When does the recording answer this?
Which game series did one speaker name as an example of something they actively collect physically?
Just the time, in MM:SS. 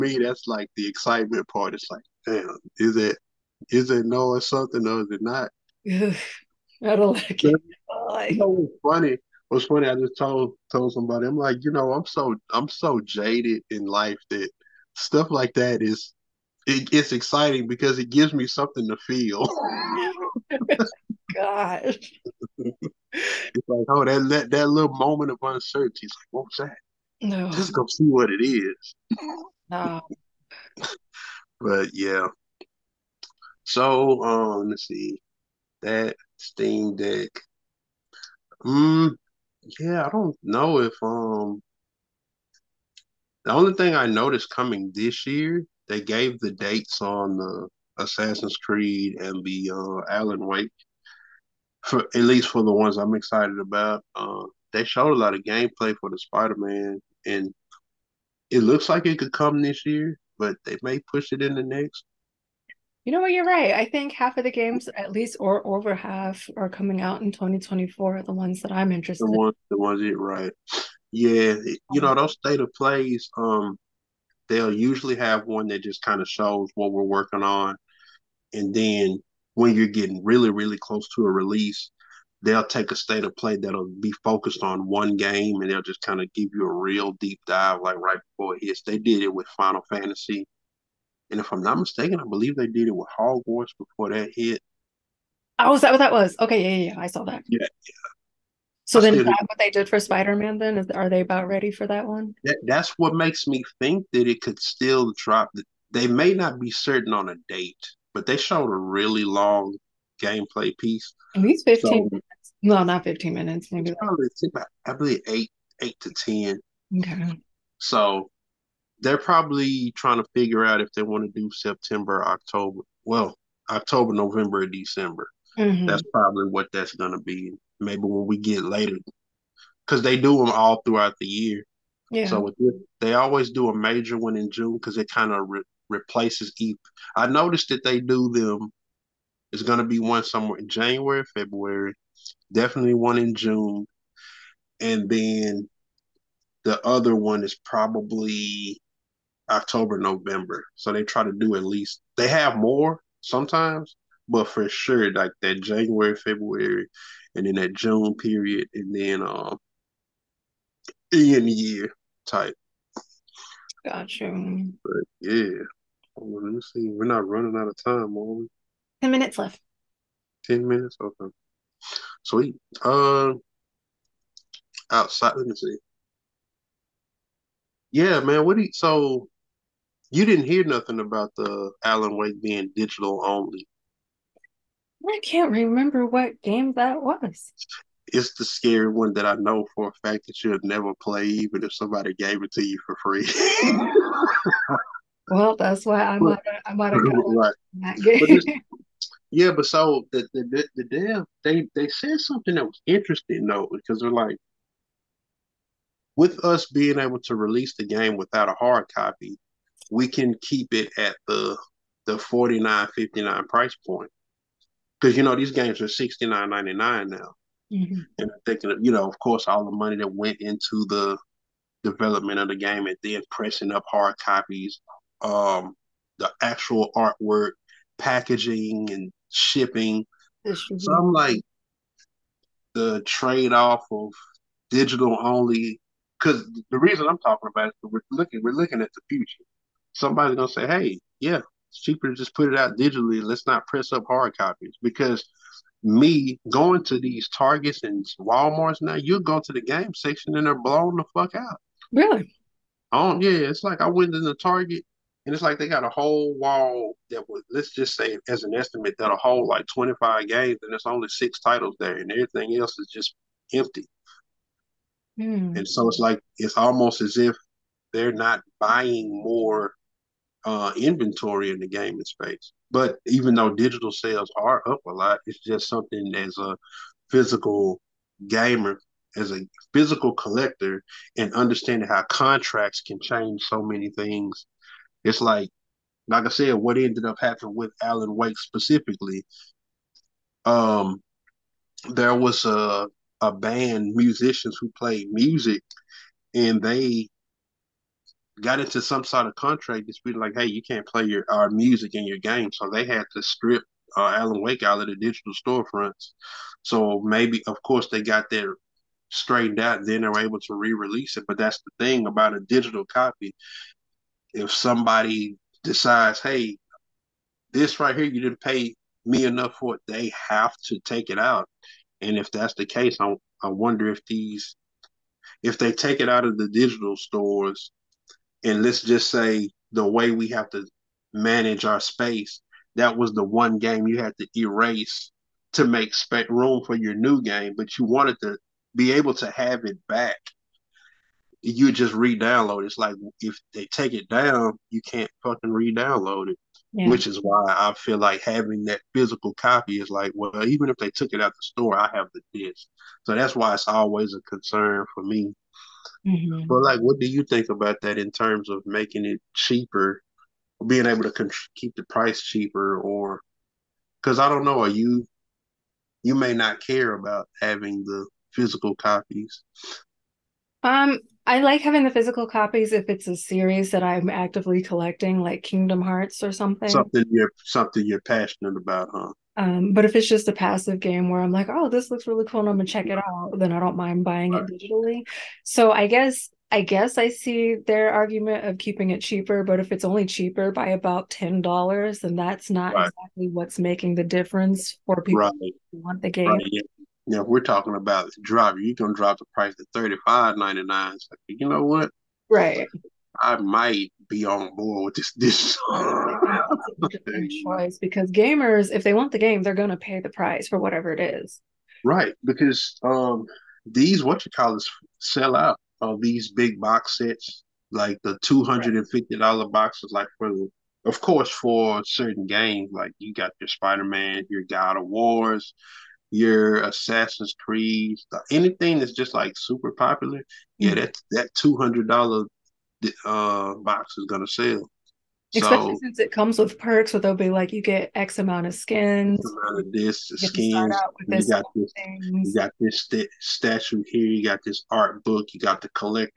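06:15.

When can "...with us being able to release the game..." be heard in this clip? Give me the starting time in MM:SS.
03:26.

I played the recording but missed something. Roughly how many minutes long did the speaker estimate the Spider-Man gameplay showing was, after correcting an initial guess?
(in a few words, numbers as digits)
8 to 10.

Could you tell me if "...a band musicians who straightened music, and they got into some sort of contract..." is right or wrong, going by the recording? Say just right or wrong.
wrong.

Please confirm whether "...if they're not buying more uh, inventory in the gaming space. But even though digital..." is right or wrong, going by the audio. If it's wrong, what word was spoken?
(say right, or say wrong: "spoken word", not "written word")
right.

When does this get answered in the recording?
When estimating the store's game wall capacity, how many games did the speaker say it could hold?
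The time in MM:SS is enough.
04:19.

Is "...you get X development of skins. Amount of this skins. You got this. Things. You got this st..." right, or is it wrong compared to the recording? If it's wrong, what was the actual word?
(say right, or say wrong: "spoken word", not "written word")
wrong: "amount", not "development".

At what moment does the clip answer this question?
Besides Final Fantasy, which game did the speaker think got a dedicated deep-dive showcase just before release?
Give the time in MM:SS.
01:33.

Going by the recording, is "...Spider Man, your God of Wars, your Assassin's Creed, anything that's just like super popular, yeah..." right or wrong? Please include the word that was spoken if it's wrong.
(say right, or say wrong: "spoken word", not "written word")
right.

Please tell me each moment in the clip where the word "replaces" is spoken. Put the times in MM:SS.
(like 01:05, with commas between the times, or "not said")
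02:15.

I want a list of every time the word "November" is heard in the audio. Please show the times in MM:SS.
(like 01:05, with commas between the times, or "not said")
02:04, 02:29.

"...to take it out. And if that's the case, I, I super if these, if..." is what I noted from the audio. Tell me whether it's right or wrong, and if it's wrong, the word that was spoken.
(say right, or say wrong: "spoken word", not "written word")
wrong: "wonder", not "super".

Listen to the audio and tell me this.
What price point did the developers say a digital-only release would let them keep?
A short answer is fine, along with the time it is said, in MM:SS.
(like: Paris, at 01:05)
$49.59, at 03:32.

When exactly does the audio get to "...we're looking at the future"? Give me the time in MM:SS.
03:58.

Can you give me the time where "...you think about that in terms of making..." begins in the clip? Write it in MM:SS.
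05:57.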